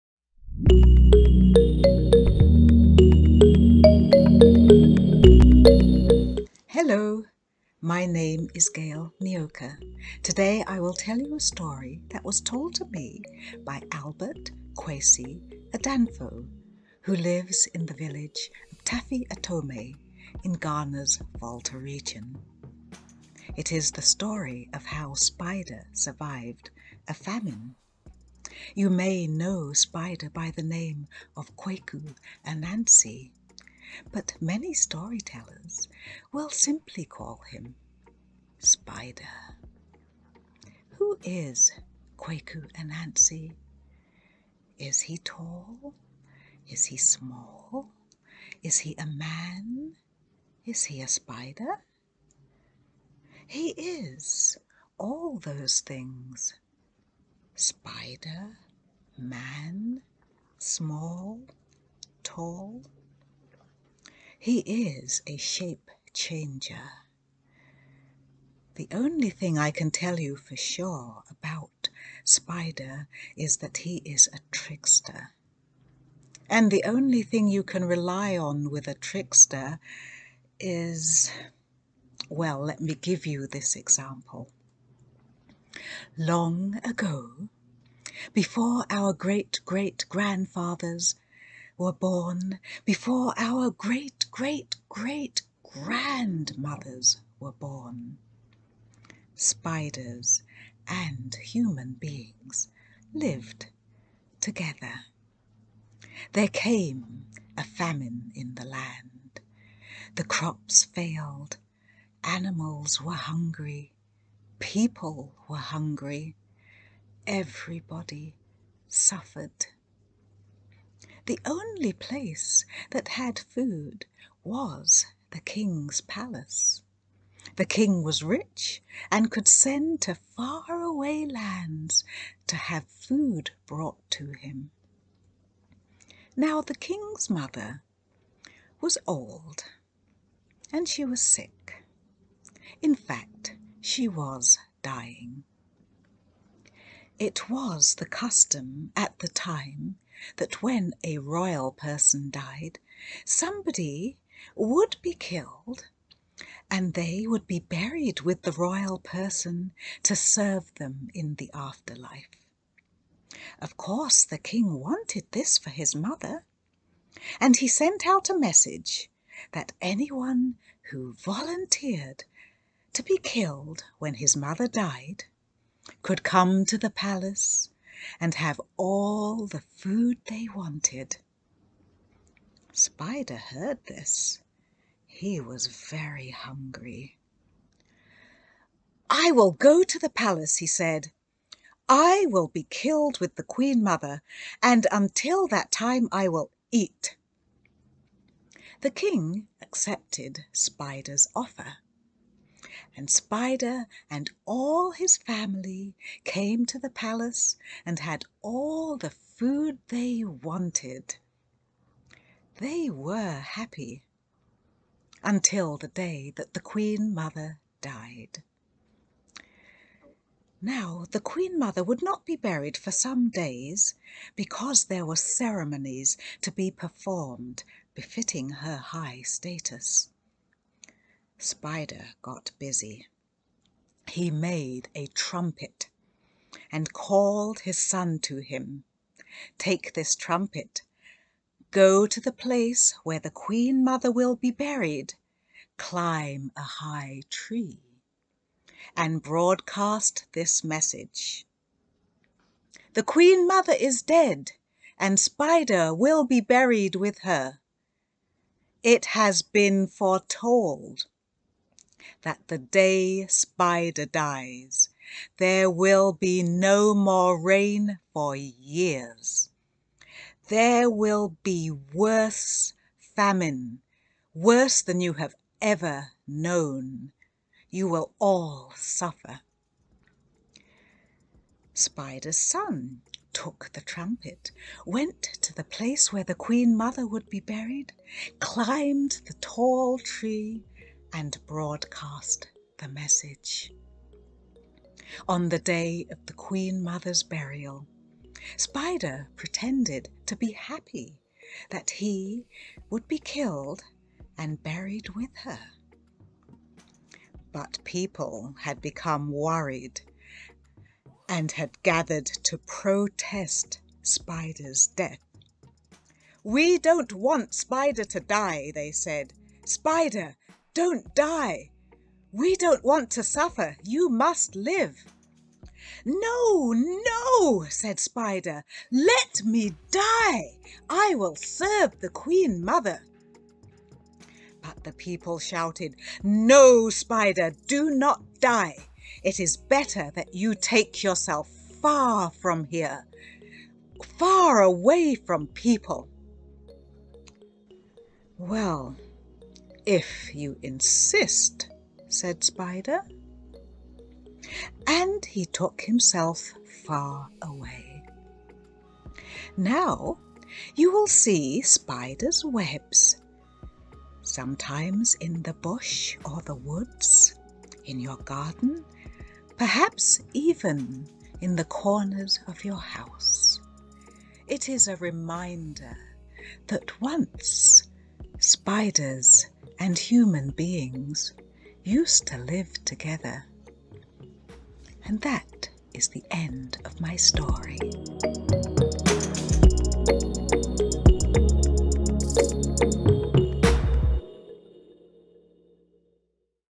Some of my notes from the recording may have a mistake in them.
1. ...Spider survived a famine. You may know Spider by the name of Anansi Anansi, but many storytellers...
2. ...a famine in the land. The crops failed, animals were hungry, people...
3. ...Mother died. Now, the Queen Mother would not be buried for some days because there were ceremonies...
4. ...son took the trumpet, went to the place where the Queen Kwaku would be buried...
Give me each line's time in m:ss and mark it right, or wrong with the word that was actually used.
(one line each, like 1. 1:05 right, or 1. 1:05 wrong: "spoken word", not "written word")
1. 0:25 wrong: "Kwaku", not "Anansi"
2. 1:47 right
3. 3:37 right
4. 4:42 wrong: "Mother", not "Kwaku".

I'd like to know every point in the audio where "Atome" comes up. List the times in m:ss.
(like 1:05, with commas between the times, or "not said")
0:19.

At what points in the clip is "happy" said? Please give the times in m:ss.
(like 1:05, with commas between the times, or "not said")
3:33, 5:00.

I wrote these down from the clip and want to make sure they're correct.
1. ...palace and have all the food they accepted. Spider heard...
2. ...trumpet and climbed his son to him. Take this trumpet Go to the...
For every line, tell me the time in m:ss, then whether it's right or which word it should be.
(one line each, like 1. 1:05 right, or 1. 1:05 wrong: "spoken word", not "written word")
1. 2:56 wrong: "wanted", not "accepted"
2. 3:55 wrong: "called", not "climbed".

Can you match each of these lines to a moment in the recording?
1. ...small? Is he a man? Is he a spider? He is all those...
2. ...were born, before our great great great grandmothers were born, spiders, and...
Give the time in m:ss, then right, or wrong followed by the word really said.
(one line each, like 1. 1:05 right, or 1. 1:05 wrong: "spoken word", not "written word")
1. 0:46 right
2. 1:31 right.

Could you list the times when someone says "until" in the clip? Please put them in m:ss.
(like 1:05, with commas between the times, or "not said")
3:14, 3:35.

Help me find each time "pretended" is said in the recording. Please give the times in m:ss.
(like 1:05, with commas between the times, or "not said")
4:59.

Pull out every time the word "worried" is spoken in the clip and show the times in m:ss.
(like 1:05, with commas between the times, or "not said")
5:09.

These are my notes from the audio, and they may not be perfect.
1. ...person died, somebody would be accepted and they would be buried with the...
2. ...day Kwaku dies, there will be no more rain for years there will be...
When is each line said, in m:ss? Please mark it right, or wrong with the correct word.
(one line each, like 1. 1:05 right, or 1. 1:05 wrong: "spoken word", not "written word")
1. 2:31 wrong: "killed", not "accepted"
2. 4:22 wrong: "Spider", not "Kwaku".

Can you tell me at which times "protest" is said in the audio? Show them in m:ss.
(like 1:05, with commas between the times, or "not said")
5:12.